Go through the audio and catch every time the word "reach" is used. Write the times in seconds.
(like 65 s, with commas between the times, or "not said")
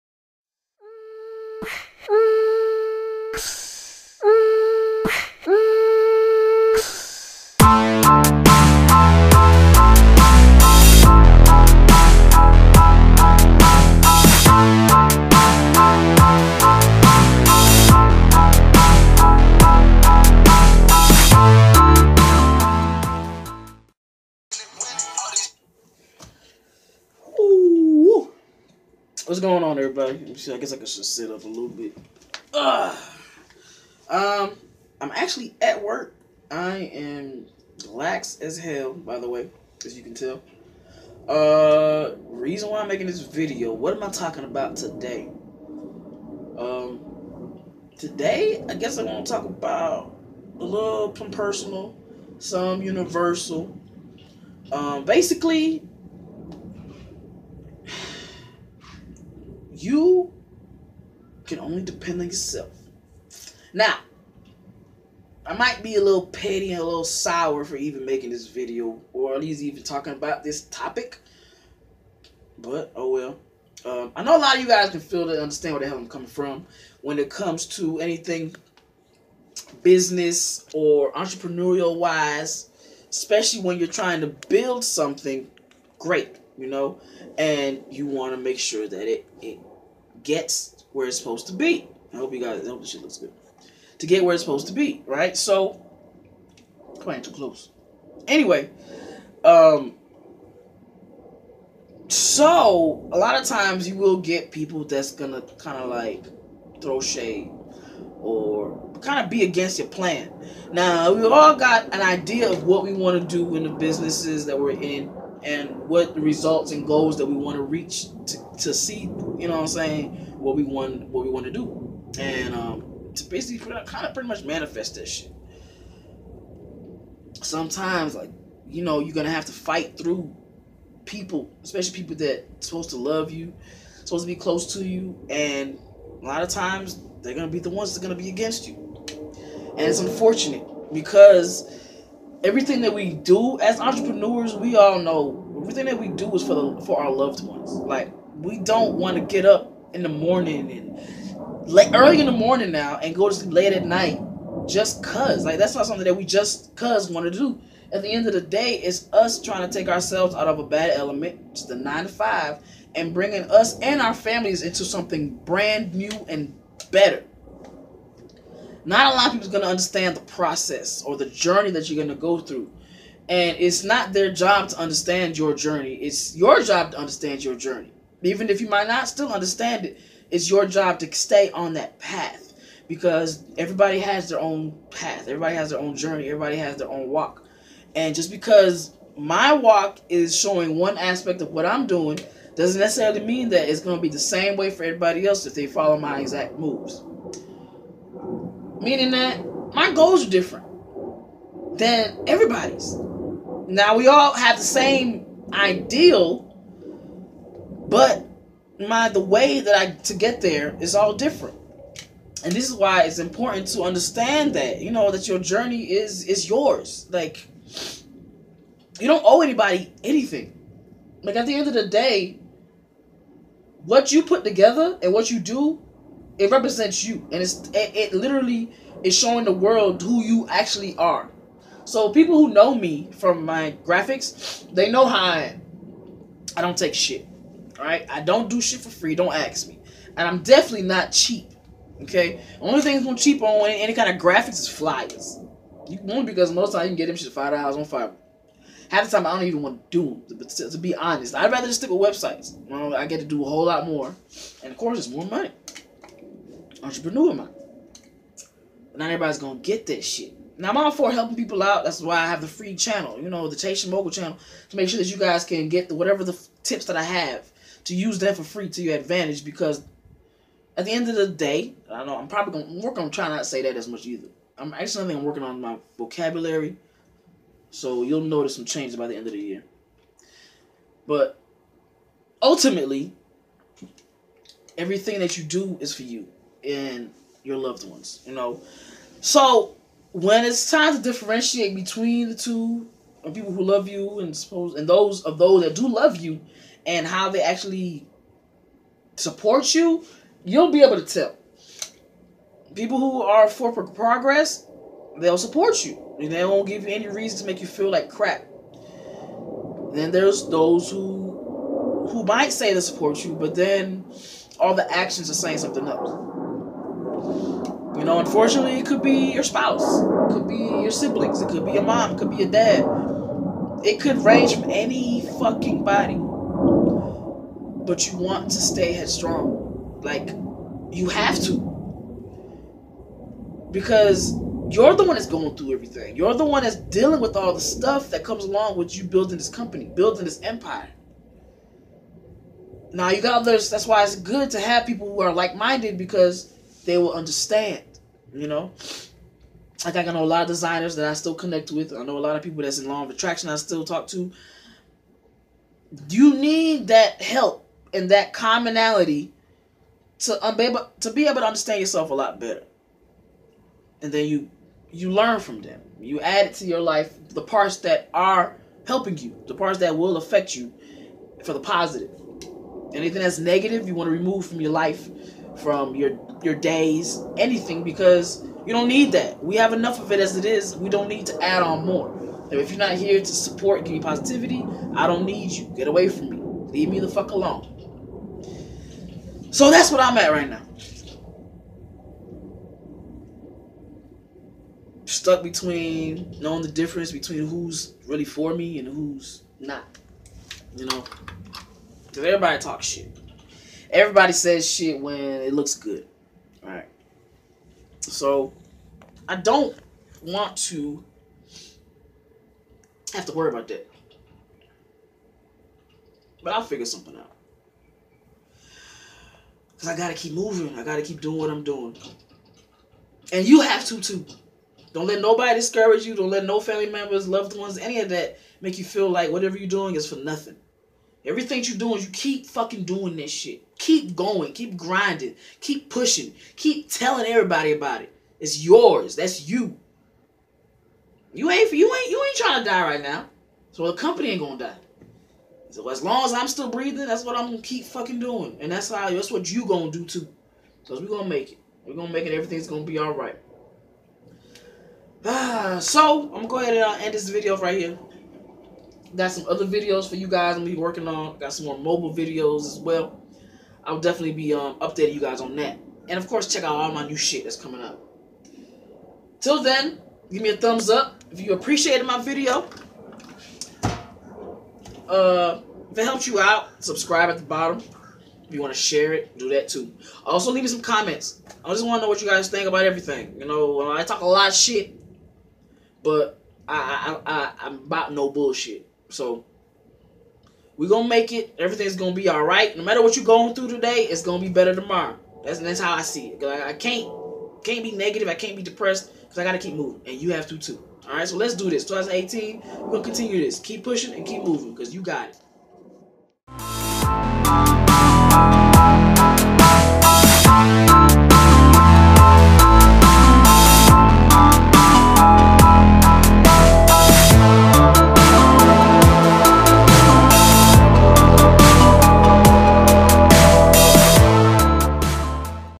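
117 s.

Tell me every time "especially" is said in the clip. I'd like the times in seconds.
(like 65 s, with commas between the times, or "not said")
83 s, 131 s.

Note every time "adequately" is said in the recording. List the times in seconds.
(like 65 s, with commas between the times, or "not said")
not said.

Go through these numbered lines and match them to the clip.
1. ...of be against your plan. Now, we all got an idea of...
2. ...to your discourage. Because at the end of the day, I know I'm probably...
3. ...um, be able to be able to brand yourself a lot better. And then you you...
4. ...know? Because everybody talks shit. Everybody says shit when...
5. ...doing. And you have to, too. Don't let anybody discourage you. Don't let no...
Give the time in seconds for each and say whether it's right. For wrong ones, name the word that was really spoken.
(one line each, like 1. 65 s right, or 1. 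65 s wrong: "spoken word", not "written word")
1. 109 s right
2. 268 s wrong: "advantage", not "discourage"
3. 360 s wrong: "understand", not "brand"
4. 400 s right
5. 421 s wrong: "nobody", not "anybody".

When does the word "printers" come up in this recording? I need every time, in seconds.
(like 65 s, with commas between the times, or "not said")
not said.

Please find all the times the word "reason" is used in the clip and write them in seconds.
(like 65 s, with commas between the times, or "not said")
42 s, 307 s.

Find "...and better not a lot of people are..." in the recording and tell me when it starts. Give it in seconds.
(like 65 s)
166 s.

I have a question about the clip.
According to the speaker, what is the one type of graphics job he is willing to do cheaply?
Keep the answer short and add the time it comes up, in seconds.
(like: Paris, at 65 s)
Flyers, at 244 s.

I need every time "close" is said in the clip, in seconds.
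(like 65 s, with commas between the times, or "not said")
97 s, 134 s.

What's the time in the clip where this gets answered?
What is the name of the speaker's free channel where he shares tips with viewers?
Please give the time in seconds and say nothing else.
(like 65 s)
263 s.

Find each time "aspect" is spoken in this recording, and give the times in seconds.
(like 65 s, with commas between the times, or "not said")
190 s.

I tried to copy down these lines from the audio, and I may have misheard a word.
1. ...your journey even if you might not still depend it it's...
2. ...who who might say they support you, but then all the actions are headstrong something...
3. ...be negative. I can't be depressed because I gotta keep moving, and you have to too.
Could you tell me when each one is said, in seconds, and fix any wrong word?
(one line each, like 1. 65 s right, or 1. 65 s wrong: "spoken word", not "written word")
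1. 177 s wrong: "understand", not "depend"
2. 310 s wrong: "saying", not "headstrong"
3. 497 s right.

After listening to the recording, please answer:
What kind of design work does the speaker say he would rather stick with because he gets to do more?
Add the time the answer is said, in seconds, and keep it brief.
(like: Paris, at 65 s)
Websites, at 252 s.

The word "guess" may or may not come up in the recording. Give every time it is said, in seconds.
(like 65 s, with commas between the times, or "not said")
30 s, 48 s.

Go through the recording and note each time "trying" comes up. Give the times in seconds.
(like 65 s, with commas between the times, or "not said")
83 s, 159 s, 273 s, 442 s.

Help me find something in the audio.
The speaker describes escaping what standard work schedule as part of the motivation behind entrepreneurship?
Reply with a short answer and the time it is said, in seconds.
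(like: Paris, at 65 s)
Nine to five, at 161 s.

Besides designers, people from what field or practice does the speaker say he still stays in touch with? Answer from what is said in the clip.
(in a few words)
Law of attraction.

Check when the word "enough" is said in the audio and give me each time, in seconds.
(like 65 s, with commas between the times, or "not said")
379 s.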